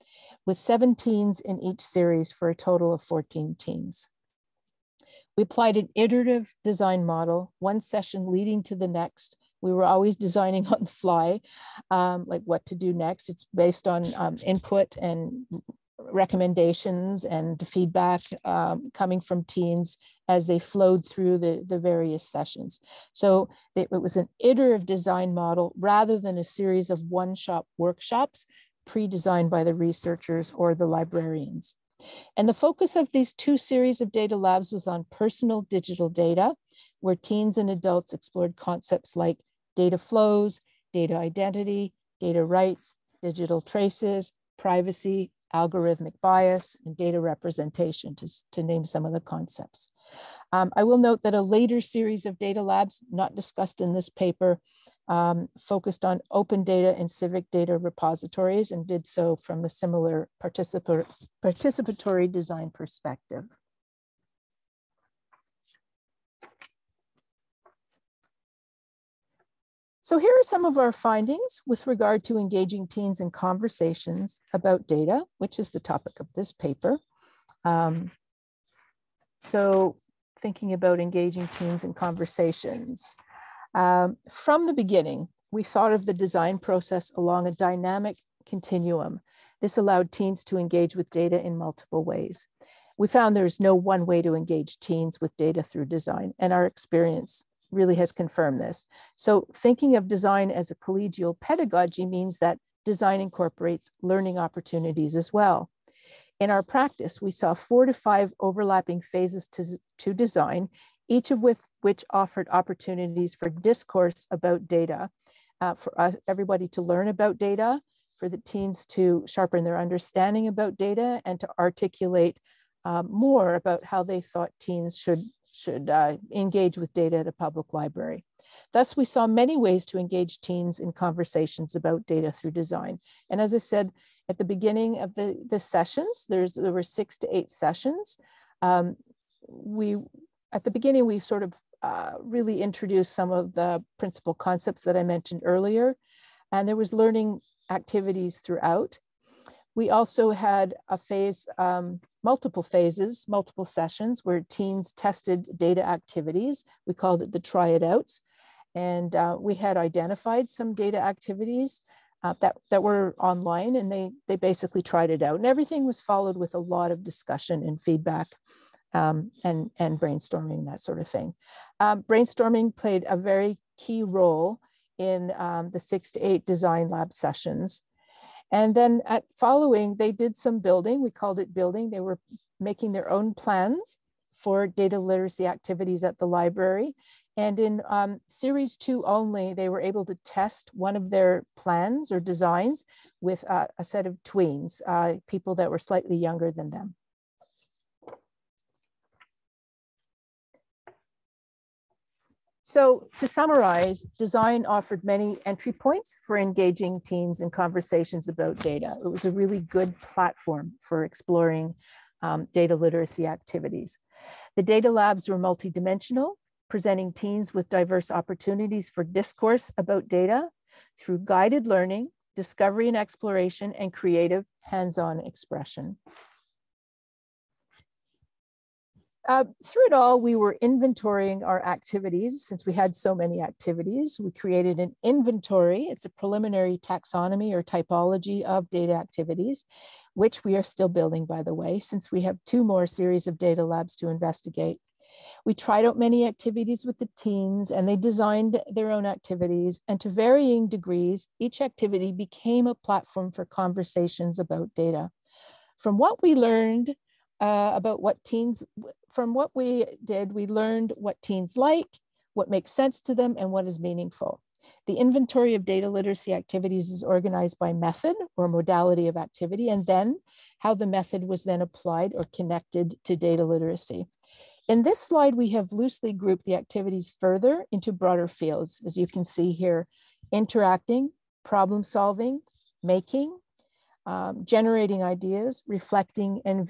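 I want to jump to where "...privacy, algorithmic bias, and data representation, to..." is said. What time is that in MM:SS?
00:44.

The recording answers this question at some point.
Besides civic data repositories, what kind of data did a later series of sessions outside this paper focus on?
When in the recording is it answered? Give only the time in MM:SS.
00:56.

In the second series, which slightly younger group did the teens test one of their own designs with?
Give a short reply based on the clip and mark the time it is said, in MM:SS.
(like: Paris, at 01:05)
tweens, at 03:14.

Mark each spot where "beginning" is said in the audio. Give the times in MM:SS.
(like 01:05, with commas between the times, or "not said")
01:24, 02:14, 02:20.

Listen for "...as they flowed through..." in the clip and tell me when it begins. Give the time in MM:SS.
00:20.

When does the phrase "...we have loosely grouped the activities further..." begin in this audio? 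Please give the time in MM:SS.
04:35.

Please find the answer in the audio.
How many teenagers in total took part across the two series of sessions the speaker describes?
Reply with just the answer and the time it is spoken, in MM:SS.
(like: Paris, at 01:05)
14, at 00:03.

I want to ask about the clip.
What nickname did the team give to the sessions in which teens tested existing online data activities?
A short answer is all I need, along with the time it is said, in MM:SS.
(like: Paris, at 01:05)
the try it outs, at 02:37.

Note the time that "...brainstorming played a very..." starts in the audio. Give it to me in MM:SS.
02:52.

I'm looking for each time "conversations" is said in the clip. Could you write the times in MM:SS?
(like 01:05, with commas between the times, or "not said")
01:13, 01:21, 02:10, 03:27, 04:13.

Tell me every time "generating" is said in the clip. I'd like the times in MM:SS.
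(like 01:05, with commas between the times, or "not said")
04:44.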